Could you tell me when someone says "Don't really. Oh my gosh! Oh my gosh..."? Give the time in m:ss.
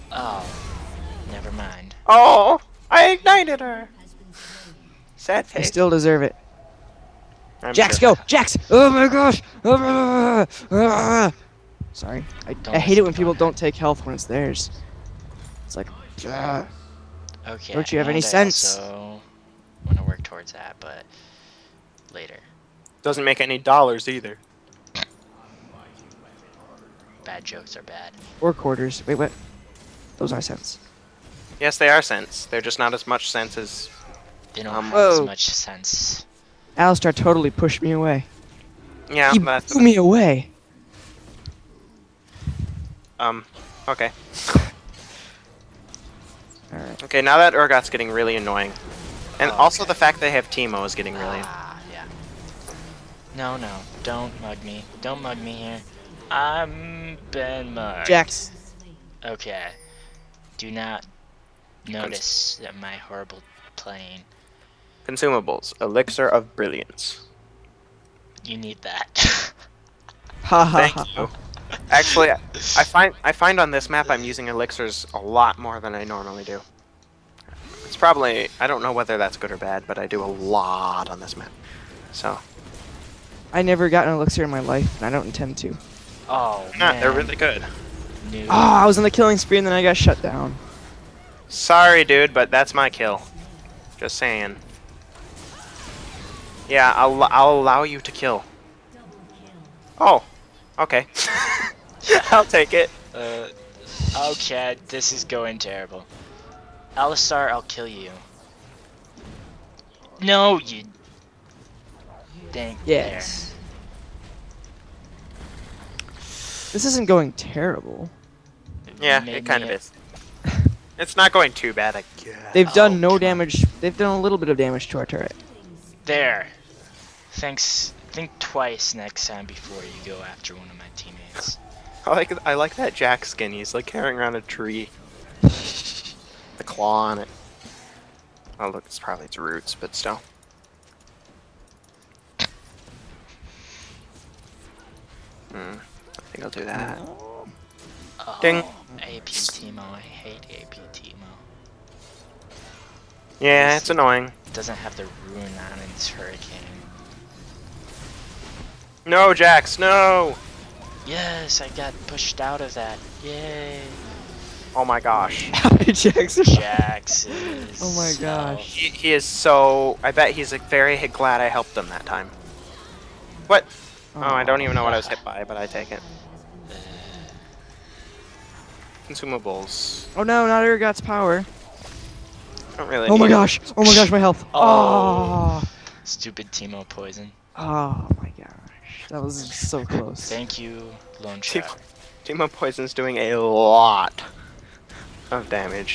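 3:02.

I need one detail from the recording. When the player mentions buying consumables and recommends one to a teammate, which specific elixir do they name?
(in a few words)
Elixir of Brilliance.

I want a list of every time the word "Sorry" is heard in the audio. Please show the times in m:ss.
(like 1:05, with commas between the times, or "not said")
0:11, 1:31.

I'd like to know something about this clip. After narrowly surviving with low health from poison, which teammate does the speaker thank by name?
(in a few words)
Lone Shark.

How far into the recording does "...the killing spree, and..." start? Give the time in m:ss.
1:29.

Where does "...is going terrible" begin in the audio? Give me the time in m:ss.
1:45.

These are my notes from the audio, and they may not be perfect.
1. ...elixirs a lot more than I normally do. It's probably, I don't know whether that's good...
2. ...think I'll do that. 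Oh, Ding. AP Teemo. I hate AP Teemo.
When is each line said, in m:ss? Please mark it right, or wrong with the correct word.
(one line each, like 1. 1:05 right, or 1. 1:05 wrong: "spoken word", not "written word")
1. 1:14 right
2. 2:26 right.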